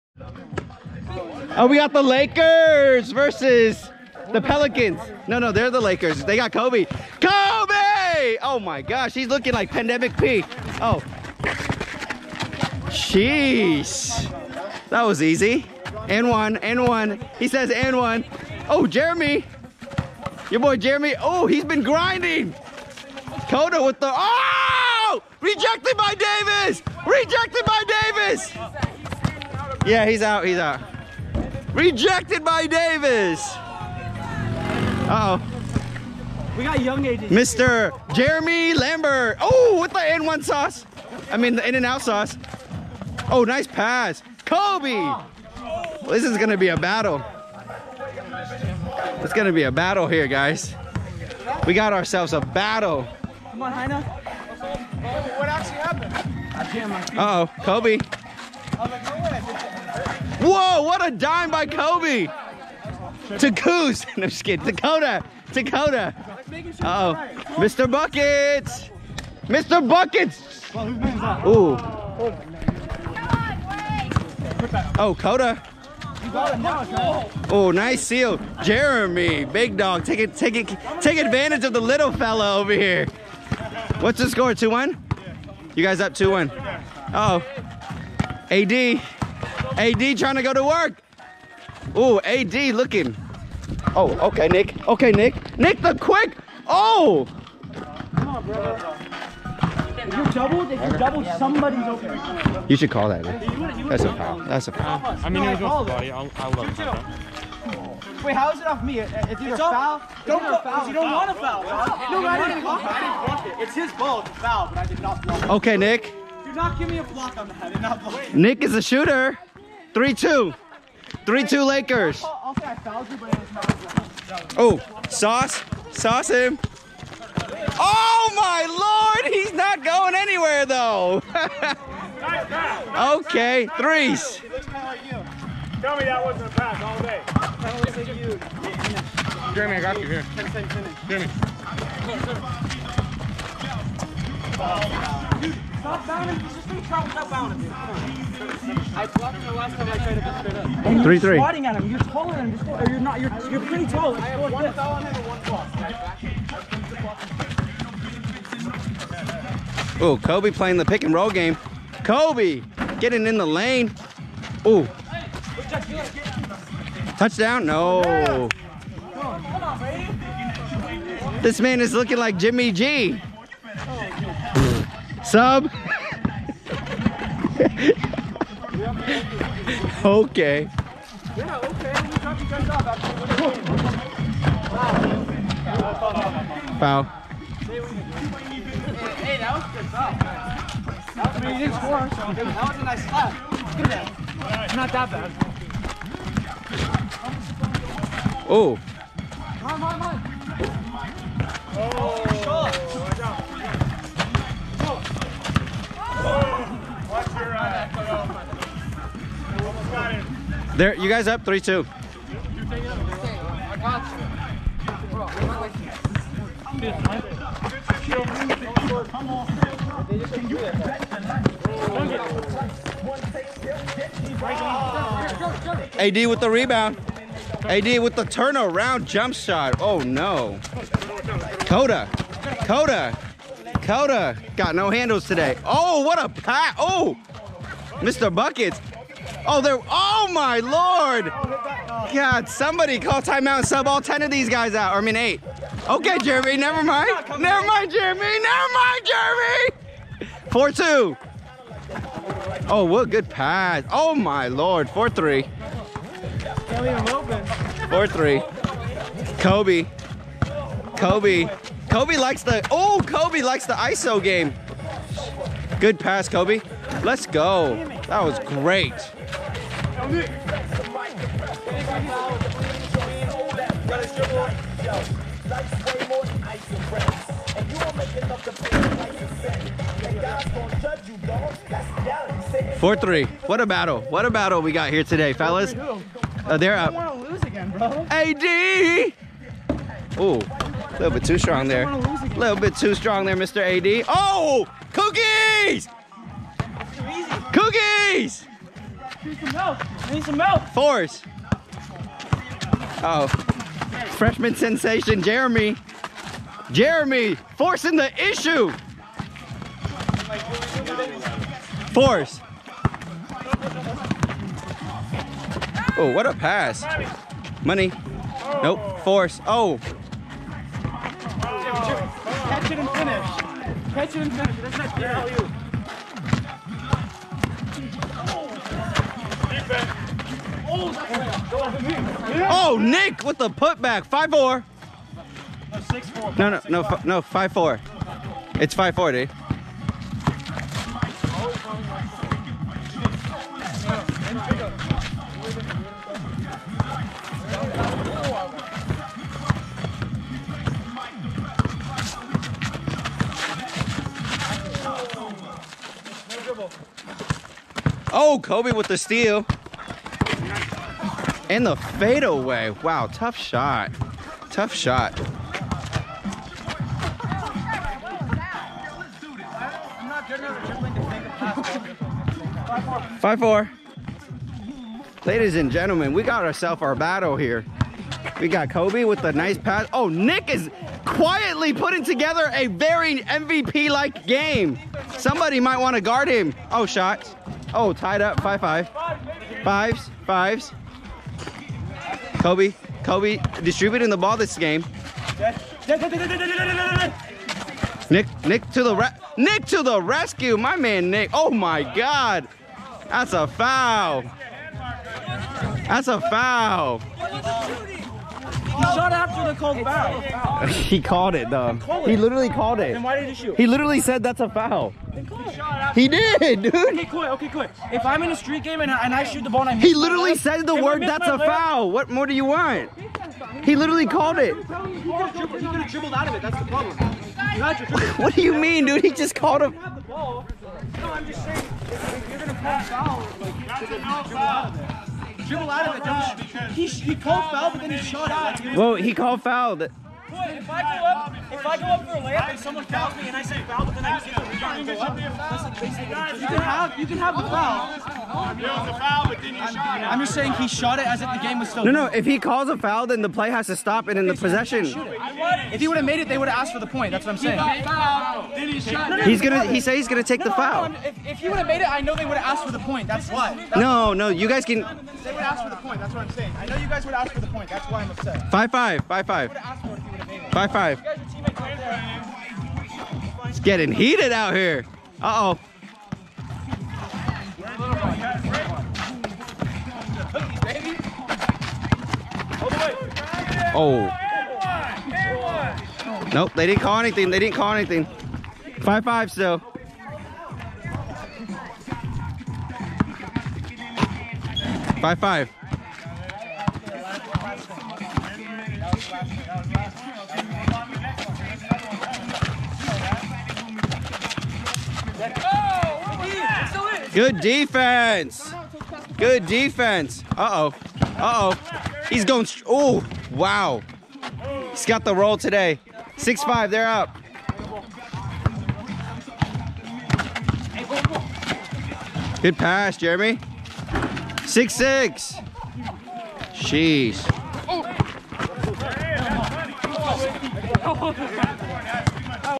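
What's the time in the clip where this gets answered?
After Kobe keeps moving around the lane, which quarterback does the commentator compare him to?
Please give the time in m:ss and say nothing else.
2:52.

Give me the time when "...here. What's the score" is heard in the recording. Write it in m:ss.
1:22.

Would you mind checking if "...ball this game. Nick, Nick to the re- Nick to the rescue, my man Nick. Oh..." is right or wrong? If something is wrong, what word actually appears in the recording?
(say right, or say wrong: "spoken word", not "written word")
right.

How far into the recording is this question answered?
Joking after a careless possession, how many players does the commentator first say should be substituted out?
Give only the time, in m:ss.
4:04.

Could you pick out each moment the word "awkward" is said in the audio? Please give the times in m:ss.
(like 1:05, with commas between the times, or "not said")
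not said.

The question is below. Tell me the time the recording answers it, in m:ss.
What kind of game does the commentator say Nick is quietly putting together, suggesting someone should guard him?
6:23.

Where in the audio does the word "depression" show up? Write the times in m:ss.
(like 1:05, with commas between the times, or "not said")
not said.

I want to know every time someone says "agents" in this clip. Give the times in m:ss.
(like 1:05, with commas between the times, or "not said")
0:37.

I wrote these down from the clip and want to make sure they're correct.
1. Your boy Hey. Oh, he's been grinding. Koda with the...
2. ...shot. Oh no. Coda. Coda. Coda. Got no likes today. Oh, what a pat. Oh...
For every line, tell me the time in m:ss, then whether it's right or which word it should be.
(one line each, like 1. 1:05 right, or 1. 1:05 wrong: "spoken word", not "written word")
1. 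0:20 wrong: "Jeremy", not "Hey"
2. 3:49 wrong: "handles", not "likes".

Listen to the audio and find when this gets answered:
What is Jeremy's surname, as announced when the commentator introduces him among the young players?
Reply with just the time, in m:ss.
0:38.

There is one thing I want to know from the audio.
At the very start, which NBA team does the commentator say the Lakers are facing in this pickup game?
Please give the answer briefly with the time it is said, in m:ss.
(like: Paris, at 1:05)
Pelicans, at 0:04.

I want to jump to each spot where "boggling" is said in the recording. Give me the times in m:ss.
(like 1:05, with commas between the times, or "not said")
not said.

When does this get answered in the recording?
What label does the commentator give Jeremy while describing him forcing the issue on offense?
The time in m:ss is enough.
5:04.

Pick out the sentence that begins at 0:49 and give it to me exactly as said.
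It's going to be a battle here, guys.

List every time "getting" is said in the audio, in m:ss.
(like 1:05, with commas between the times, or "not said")
2:42, 7:53.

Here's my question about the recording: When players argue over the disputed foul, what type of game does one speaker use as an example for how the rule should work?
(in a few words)
street game.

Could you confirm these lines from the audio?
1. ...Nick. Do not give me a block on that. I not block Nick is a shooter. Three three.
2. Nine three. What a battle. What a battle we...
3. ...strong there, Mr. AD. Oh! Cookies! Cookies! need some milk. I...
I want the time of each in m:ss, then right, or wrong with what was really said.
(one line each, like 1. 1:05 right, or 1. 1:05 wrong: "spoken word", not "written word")
1. 1:55 wrong: "two", not "three"
2. 4:42 wrong: "Four", not "Nine"
3. 4:52 right.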